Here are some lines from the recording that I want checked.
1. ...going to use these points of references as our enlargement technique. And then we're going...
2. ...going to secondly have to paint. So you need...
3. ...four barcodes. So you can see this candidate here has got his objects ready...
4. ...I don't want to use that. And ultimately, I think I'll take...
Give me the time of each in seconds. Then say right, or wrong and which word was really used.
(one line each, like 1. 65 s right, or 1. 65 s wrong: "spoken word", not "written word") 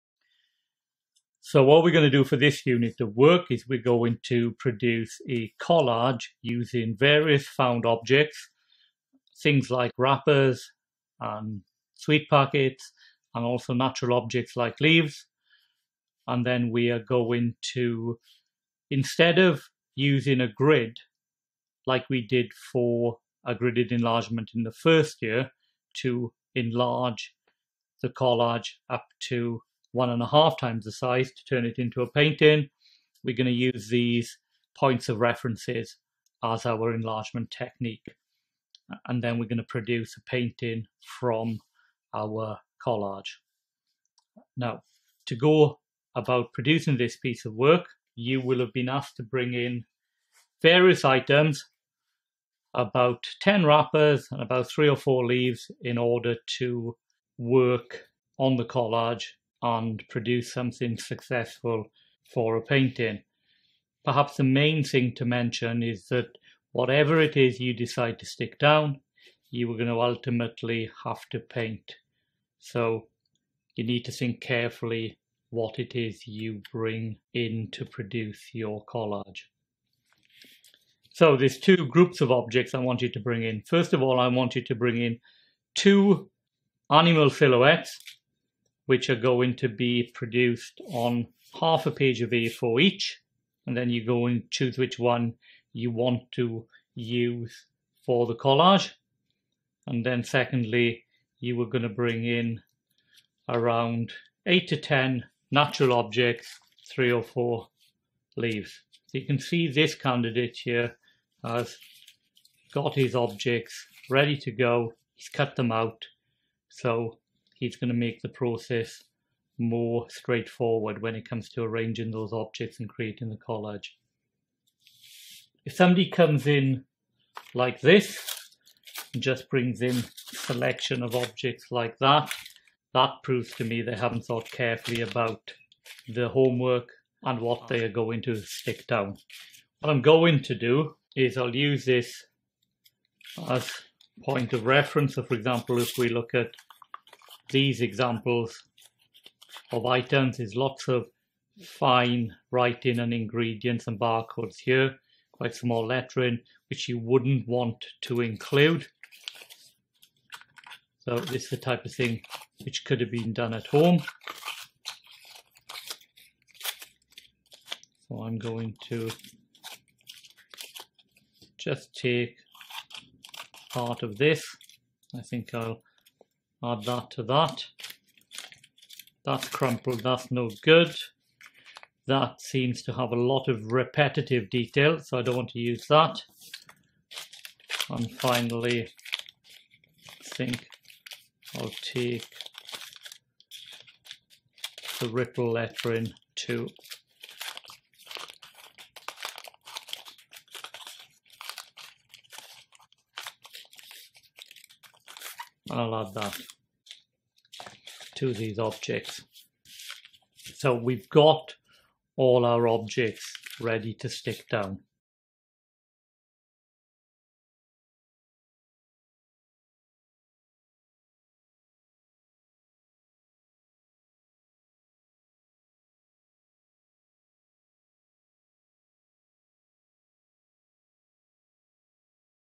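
1. 33 s right
2. 69 s wrong: "ultimately", not "secondly"
3. 107 s wrong: "leaves", not "barcodes"
4. 185 s wrong: "finally", not "ultimately".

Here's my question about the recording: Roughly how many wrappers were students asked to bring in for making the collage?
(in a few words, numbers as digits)
10.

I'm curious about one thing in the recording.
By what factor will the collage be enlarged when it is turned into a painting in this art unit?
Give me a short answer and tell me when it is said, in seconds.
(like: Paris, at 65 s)
1.5 times, at 29 s.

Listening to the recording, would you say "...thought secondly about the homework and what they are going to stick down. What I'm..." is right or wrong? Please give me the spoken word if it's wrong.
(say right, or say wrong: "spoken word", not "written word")
wrong: "carefully", not "secondly".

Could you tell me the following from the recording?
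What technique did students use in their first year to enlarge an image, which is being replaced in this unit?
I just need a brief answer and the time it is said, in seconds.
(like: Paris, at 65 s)
gridded enlargement, at 23 s.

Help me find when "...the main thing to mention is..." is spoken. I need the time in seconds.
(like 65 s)
64 s.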